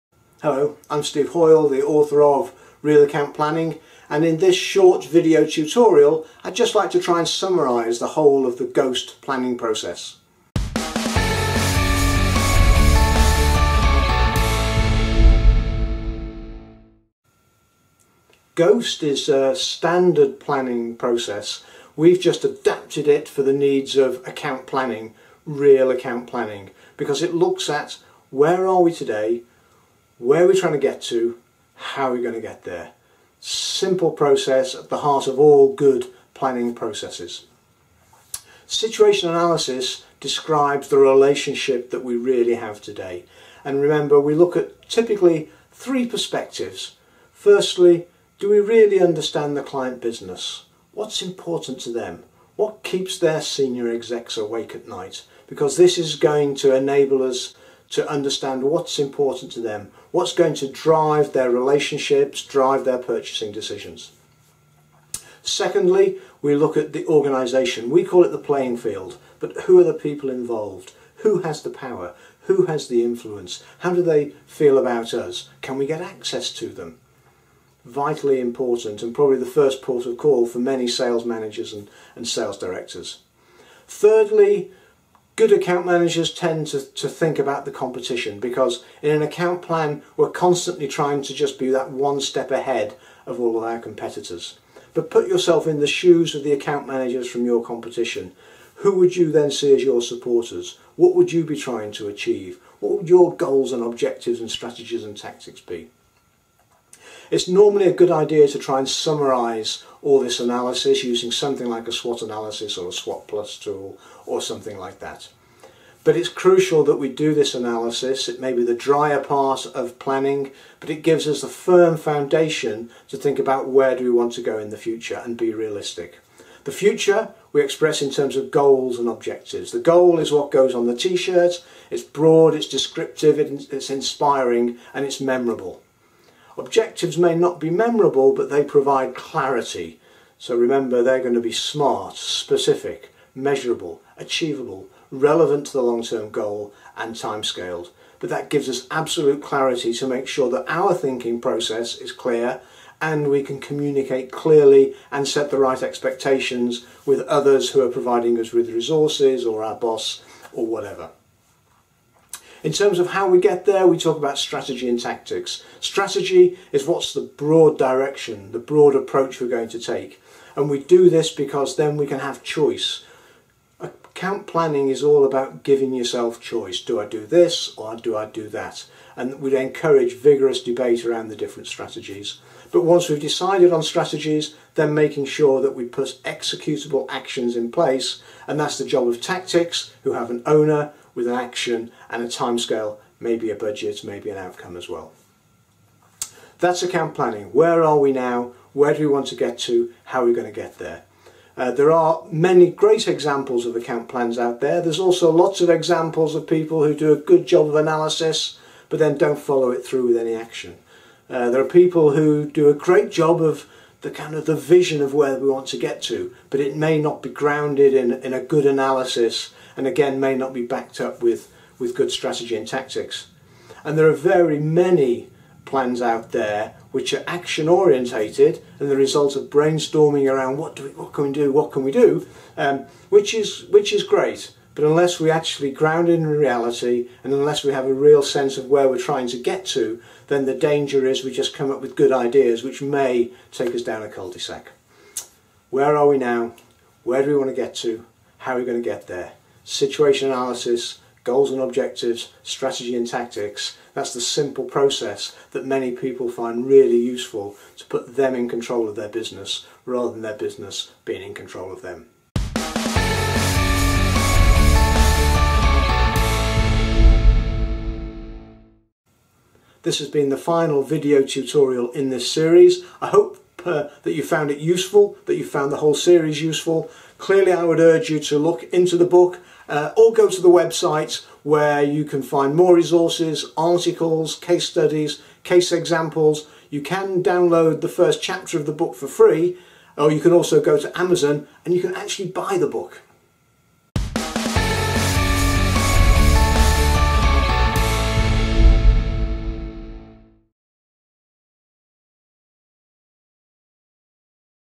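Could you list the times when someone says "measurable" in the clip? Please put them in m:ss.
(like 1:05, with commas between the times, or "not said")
2:23.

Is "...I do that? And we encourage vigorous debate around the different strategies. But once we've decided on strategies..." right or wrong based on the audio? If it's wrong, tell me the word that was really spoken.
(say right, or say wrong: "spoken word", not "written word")
right.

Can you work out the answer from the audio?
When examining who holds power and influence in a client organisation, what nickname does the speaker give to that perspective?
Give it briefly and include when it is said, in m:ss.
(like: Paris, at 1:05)
the playing field, at 1:08.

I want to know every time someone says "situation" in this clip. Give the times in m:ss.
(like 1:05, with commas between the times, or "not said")
0:38, 4:09.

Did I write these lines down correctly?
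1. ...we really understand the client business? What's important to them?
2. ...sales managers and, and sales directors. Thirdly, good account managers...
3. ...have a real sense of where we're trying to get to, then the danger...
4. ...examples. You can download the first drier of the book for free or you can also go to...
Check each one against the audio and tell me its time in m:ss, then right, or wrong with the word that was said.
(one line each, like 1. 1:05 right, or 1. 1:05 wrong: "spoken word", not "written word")
1. 0:48 right
2. 1:20 right
3. 3:57 right
4. 4:45 wrong: "chapter", not "drier".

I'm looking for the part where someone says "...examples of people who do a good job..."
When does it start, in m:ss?
3:25.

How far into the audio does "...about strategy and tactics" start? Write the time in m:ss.
2:44.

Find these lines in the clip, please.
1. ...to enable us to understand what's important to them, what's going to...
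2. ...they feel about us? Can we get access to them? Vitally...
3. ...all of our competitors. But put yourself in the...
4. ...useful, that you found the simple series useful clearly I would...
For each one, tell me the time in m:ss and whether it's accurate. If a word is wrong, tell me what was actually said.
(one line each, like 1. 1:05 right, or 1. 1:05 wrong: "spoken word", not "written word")
1. 0:56 right
2. 1:14 right
3. 1:33 right
4. 4:34 wrong: "whole", not "simple".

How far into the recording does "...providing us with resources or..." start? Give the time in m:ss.
2:37.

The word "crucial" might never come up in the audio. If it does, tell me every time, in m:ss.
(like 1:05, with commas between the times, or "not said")
1:56.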